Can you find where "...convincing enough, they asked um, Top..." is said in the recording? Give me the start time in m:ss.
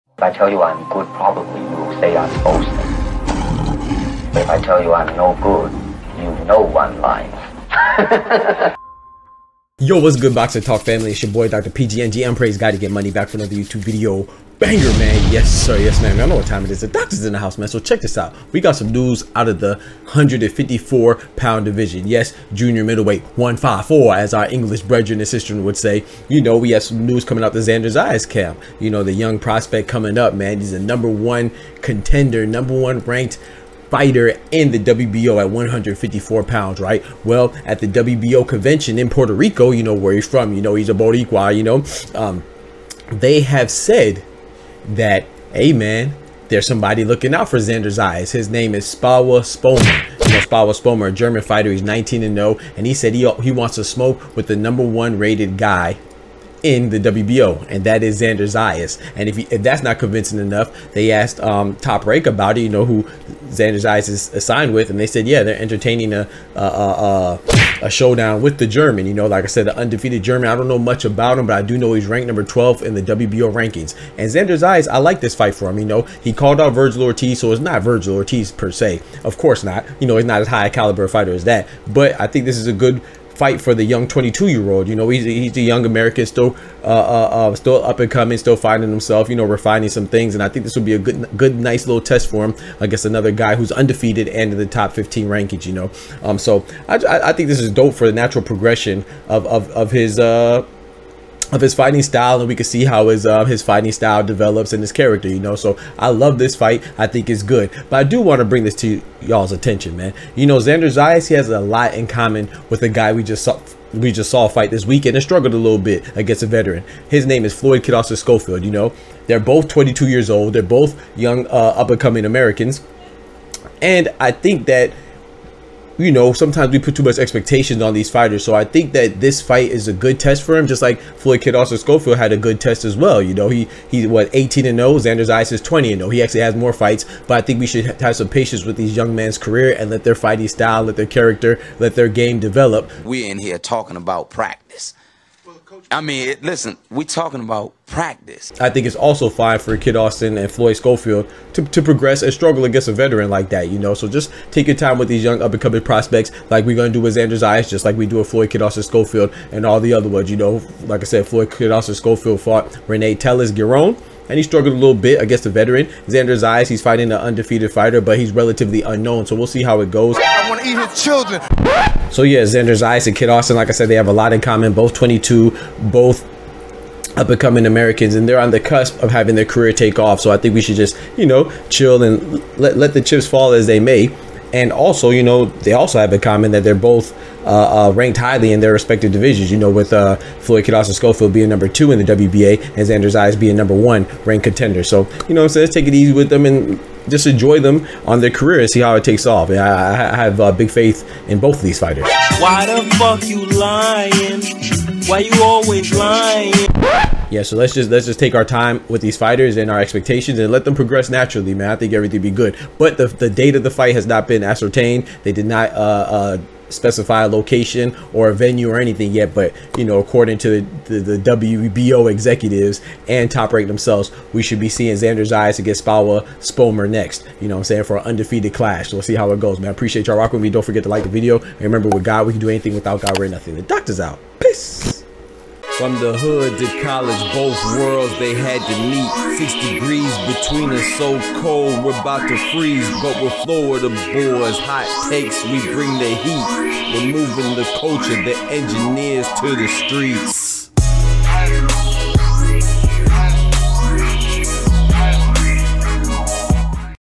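0:59.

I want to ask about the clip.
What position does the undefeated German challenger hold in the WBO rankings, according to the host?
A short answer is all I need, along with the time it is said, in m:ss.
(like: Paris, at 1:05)
12, at 1:12.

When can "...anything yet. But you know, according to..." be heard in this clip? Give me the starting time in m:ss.
3:38.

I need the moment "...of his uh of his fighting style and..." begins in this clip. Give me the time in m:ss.
1:39.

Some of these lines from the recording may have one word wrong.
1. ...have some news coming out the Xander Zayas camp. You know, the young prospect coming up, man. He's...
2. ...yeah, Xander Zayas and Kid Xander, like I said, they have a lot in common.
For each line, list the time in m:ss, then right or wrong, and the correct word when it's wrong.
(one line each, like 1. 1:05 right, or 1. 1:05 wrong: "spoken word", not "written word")
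1. 0:26 right
2. 2:52 wrong: "Austin", not "Xander".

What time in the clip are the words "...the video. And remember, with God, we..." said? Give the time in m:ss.
3:51.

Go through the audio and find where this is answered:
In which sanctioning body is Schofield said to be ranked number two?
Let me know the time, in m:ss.
3:12.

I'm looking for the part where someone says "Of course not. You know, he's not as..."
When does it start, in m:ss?
1:19.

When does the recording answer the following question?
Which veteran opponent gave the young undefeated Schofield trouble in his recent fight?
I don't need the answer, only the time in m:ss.
2:42.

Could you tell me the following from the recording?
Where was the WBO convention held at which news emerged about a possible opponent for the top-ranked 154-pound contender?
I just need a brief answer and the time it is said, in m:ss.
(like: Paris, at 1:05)
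Puerto Rico, at 0:39.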